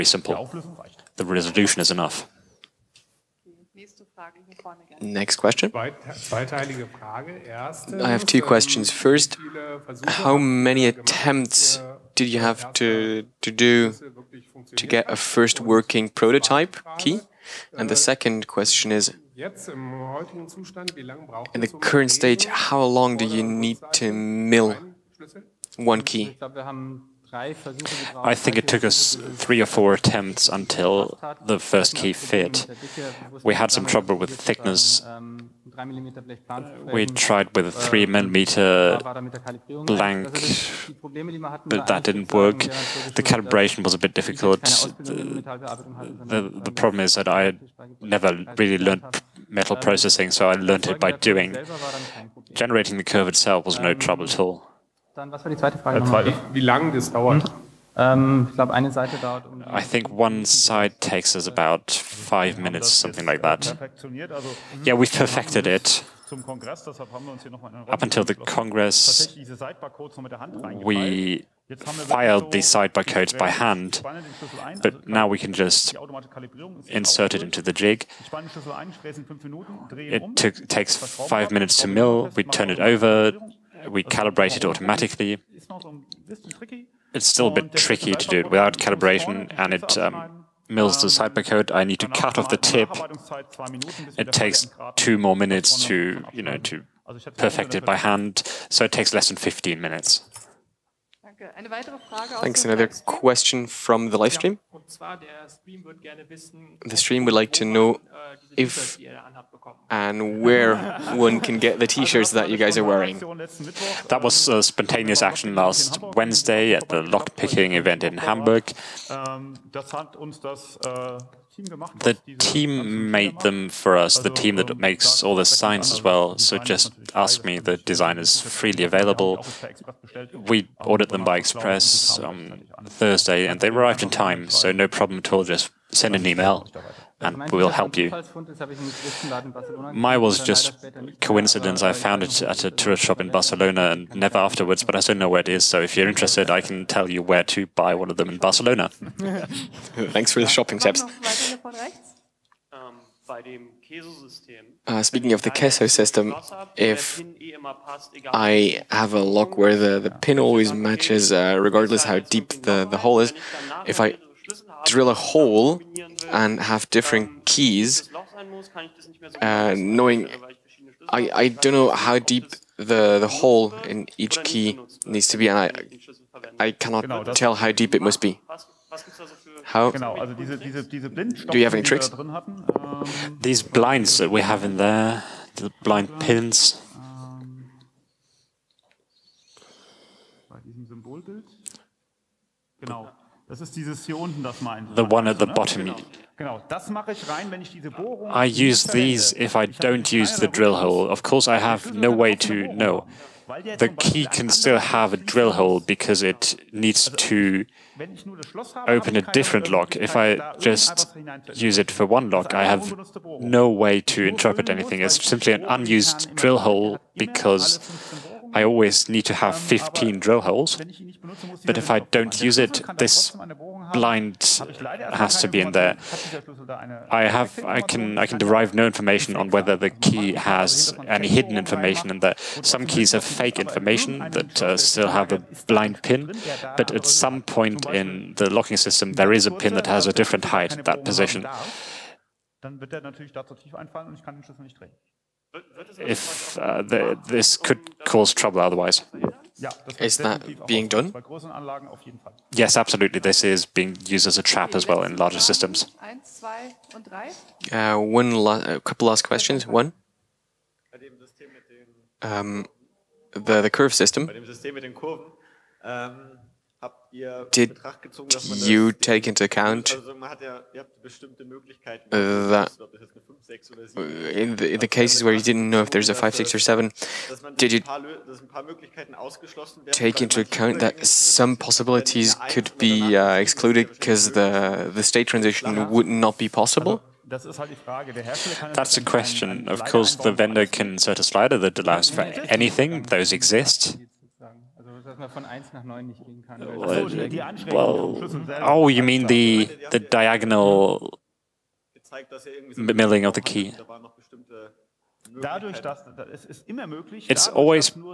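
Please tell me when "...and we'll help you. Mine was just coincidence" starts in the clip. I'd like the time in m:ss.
2:17.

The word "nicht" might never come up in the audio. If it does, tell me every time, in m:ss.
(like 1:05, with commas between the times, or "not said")
4:04, 4:56.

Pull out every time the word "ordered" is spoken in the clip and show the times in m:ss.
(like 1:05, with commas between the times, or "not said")
2:10.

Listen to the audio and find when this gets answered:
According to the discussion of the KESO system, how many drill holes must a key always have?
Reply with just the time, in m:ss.
3:39.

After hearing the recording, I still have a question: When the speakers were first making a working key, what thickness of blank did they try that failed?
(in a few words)
3 millimeter.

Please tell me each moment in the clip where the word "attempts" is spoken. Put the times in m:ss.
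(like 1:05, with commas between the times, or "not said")
0:10, 0:29.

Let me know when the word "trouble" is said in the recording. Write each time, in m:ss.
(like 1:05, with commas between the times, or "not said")
0:33, 0:53, 4:08.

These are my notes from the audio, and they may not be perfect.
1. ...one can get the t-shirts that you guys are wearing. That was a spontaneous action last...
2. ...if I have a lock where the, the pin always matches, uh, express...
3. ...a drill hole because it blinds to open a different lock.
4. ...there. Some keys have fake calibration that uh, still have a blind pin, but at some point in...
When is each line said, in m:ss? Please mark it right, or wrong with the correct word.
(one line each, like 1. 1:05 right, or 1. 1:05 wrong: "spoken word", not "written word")
1. 1:51 right
2. 2:36 wrong: "regardless", not "express"
3. 3:25 wrong: "needs", not "blinds"
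4. 3:52 wrong: "information", not "calibration".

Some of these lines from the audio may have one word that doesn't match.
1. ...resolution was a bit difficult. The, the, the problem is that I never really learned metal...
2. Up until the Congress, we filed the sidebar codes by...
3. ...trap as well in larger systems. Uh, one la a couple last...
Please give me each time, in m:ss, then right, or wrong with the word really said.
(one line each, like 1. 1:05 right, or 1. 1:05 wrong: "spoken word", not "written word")
1. 0:43 wrong: "calibration", not "resolution"
2. 1:07 right
3. 4:14 right.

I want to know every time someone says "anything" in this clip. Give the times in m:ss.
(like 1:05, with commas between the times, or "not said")
3:34, 4:52.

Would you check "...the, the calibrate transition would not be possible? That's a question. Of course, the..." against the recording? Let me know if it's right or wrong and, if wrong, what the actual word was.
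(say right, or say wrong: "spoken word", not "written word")
wrong: "state", not "calibrate".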